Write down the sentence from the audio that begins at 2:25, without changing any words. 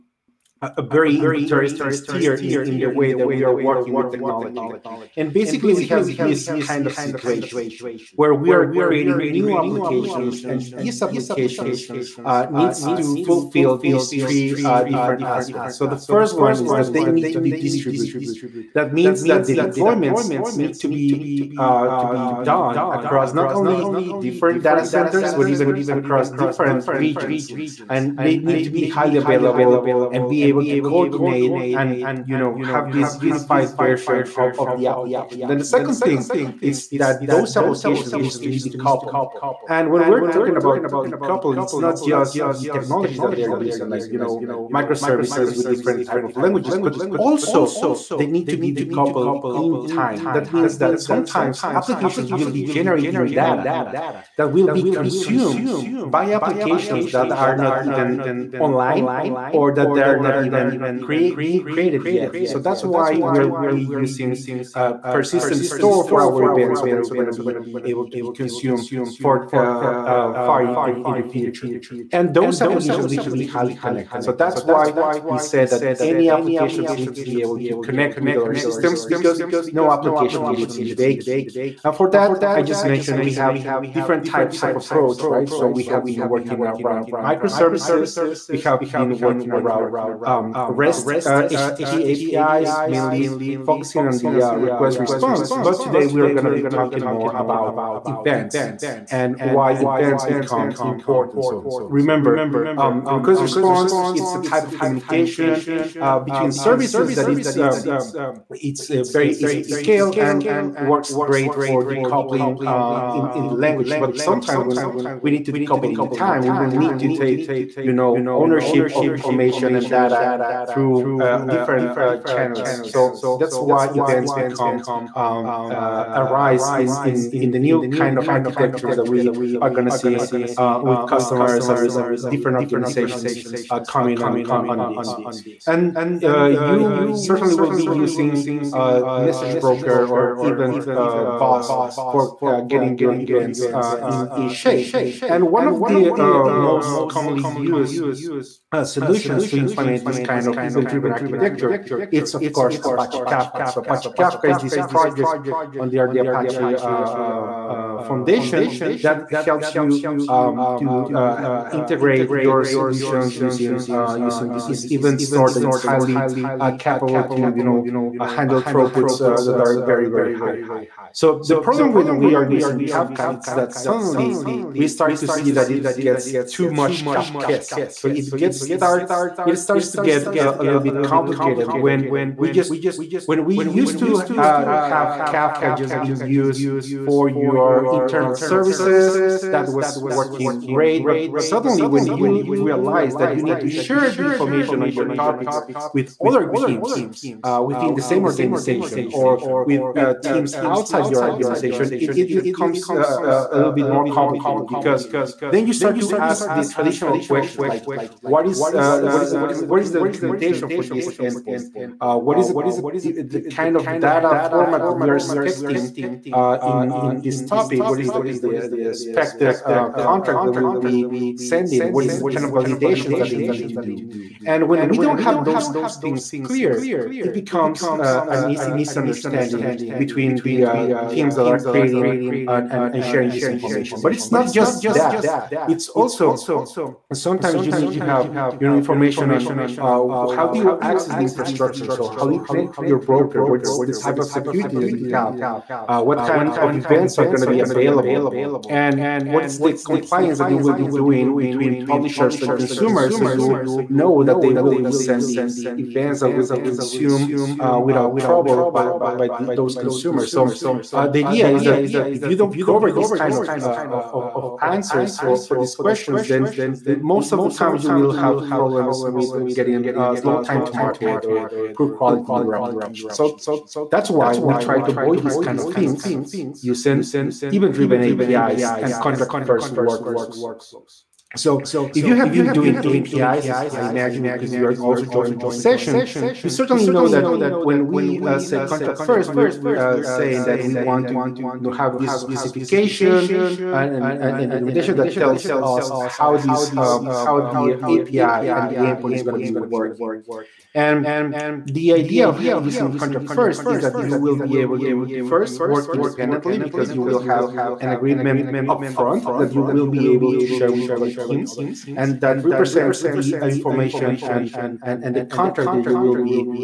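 And one of the uh, most commonly used solutions to implement this kind of event-driven architecture, it's of course Apache Kafka.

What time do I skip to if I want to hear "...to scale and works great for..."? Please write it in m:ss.
1:49.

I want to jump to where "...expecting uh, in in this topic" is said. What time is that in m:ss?
3:35.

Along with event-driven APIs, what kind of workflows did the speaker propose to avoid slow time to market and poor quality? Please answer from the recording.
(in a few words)
Contract-first workflows.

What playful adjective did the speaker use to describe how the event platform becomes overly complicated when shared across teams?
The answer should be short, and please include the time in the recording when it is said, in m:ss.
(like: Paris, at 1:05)
Kafkaesque, at 2:57.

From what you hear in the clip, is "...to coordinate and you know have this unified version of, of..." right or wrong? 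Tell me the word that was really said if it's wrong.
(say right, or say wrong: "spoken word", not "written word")
right.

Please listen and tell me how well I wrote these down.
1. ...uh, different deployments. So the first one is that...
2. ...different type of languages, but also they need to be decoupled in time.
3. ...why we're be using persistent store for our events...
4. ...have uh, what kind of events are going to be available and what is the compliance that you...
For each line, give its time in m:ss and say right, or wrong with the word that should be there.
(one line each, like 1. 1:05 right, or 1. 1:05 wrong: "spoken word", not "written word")
1. 0:14 wrong: "aspects", not "deployments"
2. 0:45 right
3. 1:02 right
4. 4:05 right.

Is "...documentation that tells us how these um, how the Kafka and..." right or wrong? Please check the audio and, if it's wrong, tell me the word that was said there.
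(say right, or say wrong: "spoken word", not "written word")
wrong: "API", not "Kafka".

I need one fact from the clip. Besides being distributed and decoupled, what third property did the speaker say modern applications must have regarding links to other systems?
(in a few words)
Highly connected.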